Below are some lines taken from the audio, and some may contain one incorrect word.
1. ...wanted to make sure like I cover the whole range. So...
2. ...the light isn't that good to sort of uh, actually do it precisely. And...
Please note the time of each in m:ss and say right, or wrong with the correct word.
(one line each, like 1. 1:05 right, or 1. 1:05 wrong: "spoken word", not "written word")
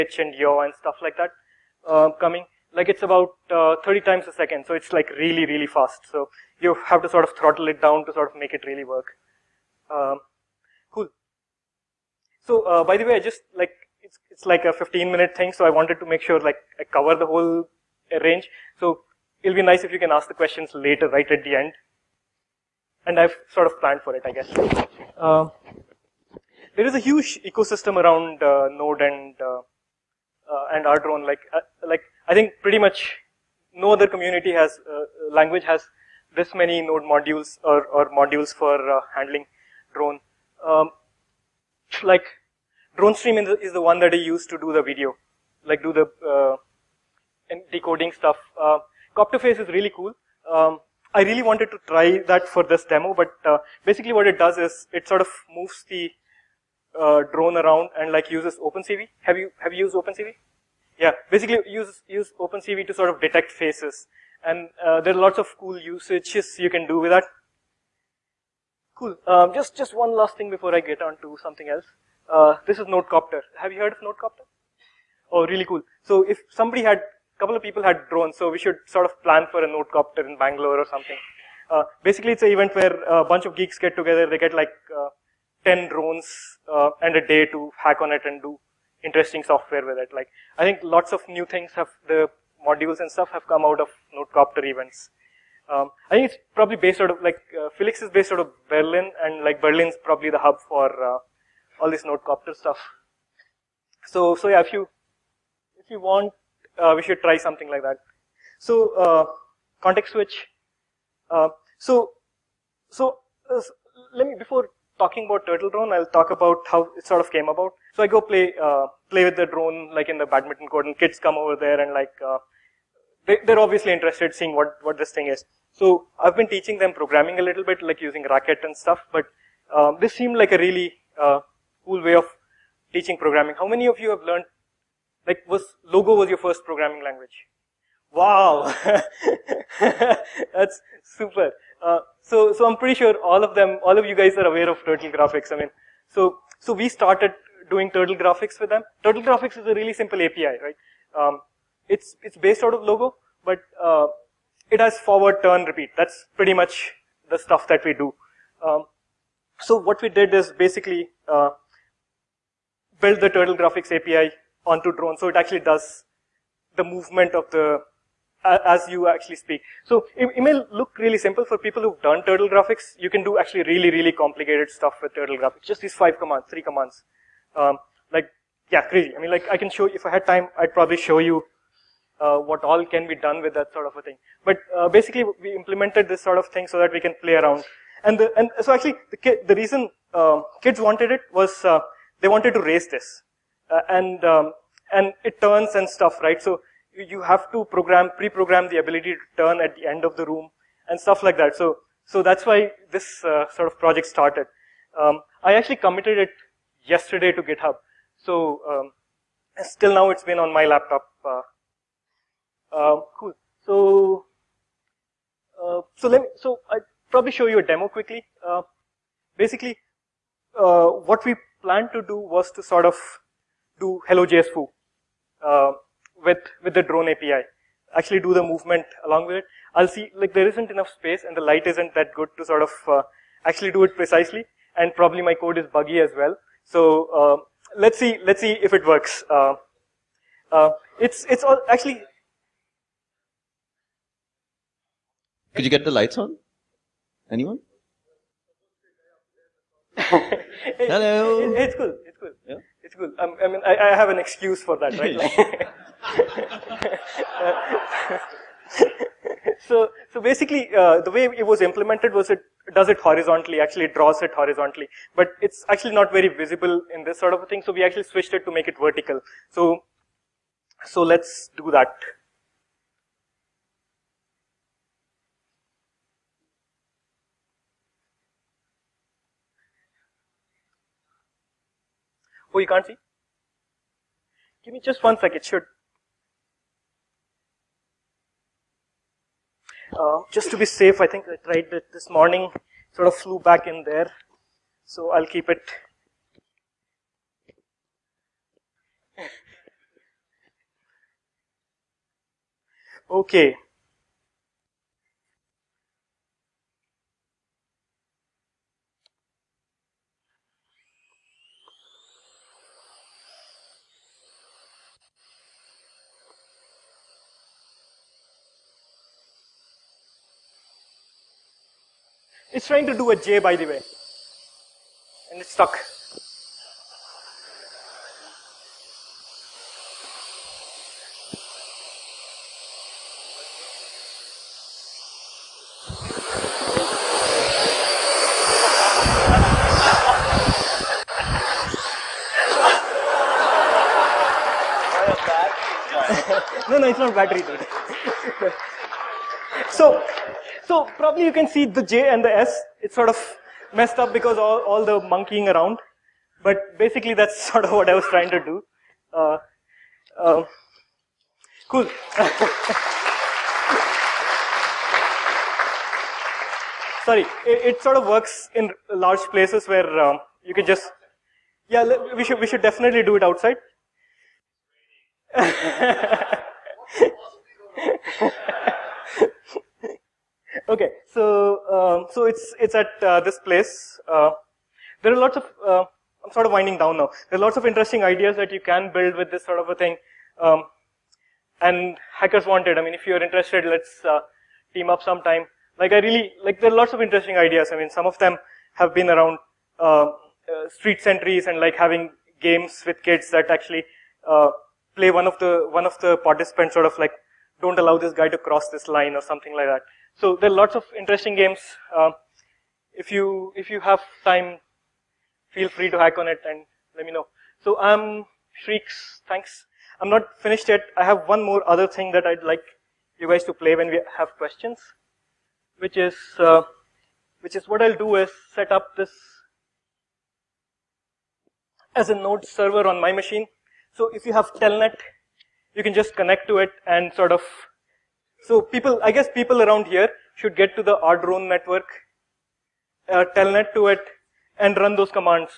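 1. 0:15 right
2. 3:51 right.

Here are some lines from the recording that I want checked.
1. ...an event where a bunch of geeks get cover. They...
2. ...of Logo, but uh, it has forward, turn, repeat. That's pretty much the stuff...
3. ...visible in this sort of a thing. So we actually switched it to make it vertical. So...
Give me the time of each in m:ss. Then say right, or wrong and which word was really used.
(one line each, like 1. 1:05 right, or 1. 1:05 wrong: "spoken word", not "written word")
1. 1:22 wrong: "together", not "cover"
2. 2:32 right
3. 4:26 right.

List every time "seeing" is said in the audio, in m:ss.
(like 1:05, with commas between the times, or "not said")
2:04.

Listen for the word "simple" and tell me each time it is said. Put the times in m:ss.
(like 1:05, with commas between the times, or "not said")
2:29, 2:51.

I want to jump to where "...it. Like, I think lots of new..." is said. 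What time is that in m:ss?
1:29.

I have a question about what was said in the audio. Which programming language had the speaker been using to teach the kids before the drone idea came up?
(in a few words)
Racket.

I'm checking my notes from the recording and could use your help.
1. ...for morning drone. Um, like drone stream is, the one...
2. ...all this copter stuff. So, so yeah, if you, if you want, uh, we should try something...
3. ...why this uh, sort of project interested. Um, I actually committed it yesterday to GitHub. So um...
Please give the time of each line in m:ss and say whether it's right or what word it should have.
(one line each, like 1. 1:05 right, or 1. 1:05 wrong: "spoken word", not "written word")
1. 0:38 wrong: "handling", not "morning"
2. 1:41 right
3. 3:22 wrong: "started", not "interested".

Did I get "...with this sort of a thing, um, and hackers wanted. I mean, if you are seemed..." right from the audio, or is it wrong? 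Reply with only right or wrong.
wrong.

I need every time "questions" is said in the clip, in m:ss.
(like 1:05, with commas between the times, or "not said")
0:20, 7:04.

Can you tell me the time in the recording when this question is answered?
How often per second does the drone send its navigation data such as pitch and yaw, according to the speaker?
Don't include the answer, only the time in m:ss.
0:03.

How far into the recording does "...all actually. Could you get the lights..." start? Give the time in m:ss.
4:01.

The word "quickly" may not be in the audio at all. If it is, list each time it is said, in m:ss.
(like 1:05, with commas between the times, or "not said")
3:37.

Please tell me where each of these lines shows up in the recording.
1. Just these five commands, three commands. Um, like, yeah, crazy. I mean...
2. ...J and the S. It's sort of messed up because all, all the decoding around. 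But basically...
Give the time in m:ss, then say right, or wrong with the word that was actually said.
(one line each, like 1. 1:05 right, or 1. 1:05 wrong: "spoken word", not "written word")
1. 2:55 right
2. 5:51 wrong: "monkeying", not "decoding".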